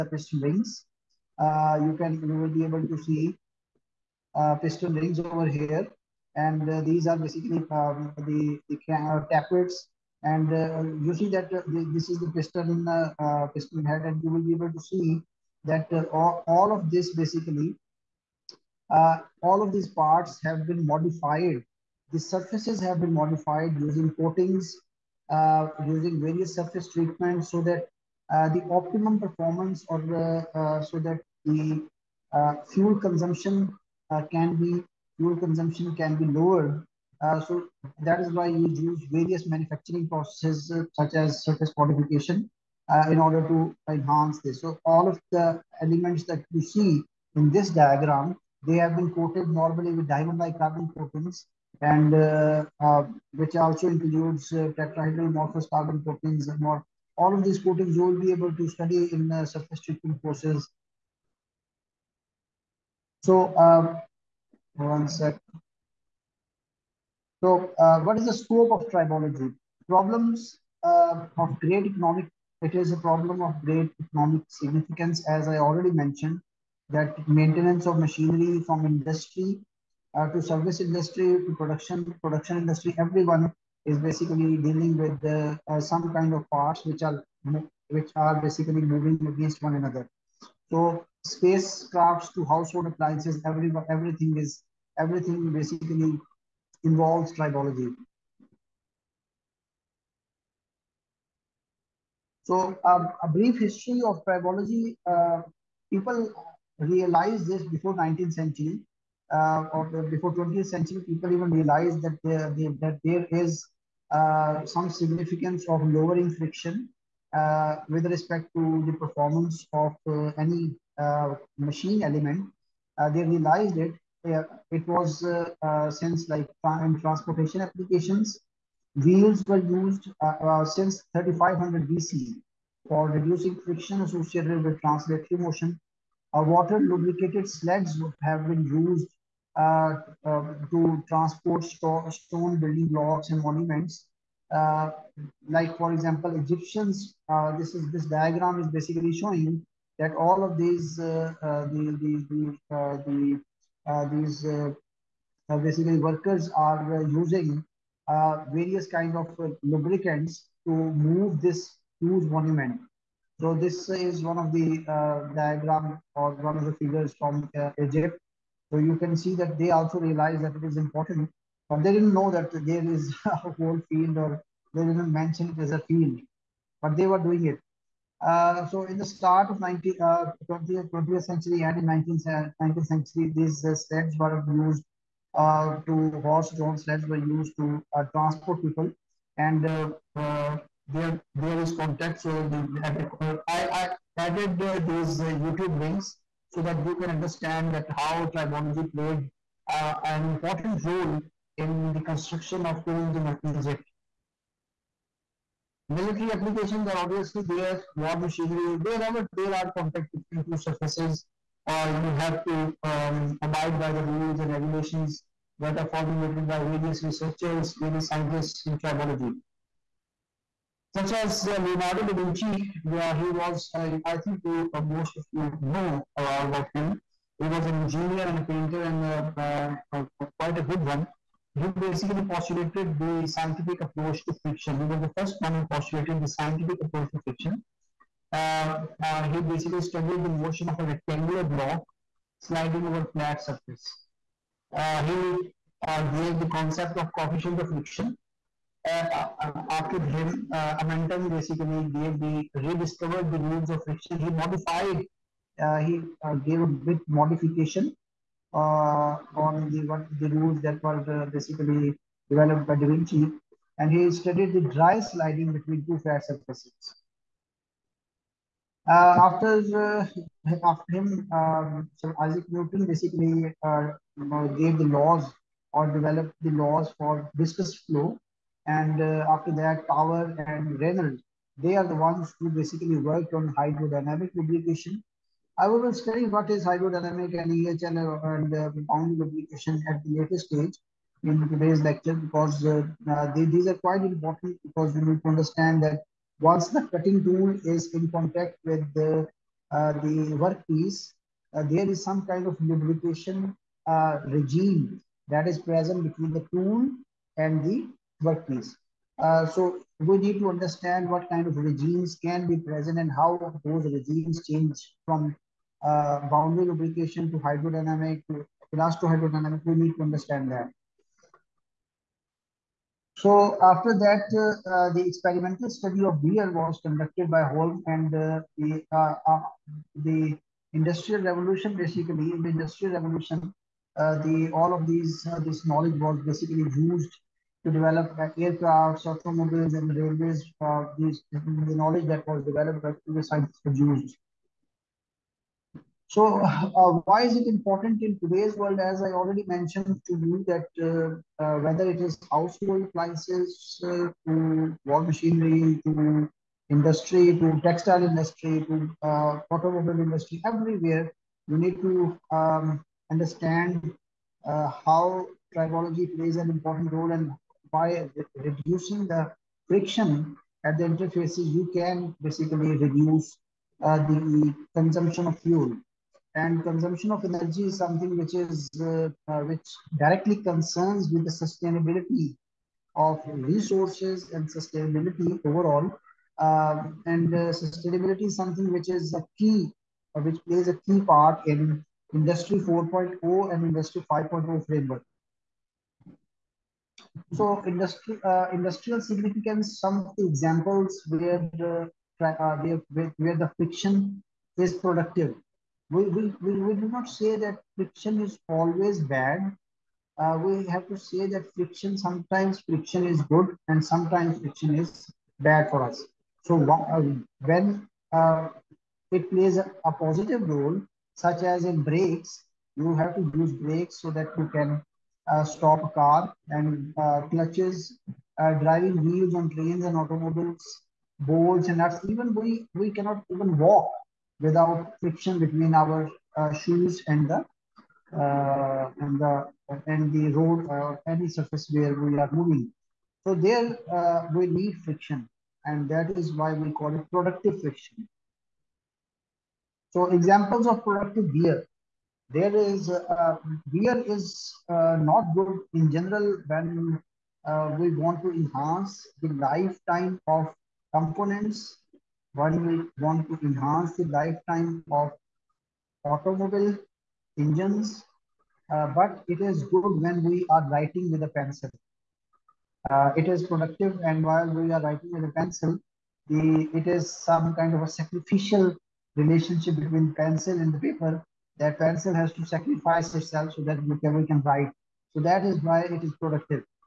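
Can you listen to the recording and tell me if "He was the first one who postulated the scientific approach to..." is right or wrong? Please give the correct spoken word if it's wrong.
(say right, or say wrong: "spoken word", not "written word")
right.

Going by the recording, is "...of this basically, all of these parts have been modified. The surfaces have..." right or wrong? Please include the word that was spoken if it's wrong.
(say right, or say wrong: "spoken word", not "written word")
right.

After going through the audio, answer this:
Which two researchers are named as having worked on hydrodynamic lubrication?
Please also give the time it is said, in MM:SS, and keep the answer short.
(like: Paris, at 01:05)
Tower and Reynolds, at 04:39.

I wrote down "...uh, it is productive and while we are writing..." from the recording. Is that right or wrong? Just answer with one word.
right.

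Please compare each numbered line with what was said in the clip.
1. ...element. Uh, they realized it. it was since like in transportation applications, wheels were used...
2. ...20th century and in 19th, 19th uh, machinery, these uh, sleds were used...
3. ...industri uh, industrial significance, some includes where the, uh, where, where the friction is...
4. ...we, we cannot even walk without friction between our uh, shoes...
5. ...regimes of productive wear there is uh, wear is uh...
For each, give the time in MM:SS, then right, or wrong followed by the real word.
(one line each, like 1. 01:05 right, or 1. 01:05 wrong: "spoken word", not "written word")
1. 02:02 right
2. 03:00 wrong: "century", not "machinery"
3. 06:37 wrong: "examples", not "includes"
4. 07:12 right
5. 07:30 wrong: "examples", not "regimes".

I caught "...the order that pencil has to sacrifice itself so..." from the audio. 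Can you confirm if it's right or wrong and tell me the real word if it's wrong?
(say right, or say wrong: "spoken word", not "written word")
wrong: "paper", not "order".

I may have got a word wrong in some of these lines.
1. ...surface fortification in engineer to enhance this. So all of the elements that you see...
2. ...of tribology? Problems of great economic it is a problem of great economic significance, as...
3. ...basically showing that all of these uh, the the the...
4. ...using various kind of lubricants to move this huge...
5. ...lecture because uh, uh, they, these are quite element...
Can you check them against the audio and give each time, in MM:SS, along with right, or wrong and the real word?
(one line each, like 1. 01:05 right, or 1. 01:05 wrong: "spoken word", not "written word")
1. 00:41 wrong: "order", not "engineer"
2. 01:08 right
3. 02:28 right
4. 02:37 right
5. 04:51 wrong: "important", not "element".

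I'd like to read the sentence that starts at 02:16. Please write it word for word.
Uh, water lubricated sleds have been used uh, um, to transport stone building blocks and monuments.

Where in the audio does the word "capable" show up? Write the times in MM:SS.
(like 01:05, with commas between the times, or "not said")
not said.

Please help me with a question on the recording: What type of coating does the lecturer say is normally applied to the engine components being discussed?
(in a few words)
Diamond-like carbon coatings.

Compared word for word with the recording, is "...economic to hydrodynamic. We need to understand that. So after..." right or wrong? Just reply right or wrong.
wrong.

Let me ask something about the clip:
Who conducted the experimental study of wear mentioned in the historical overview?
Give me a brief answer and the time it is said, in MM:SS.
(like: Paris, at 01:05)
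Holm, at 05:27.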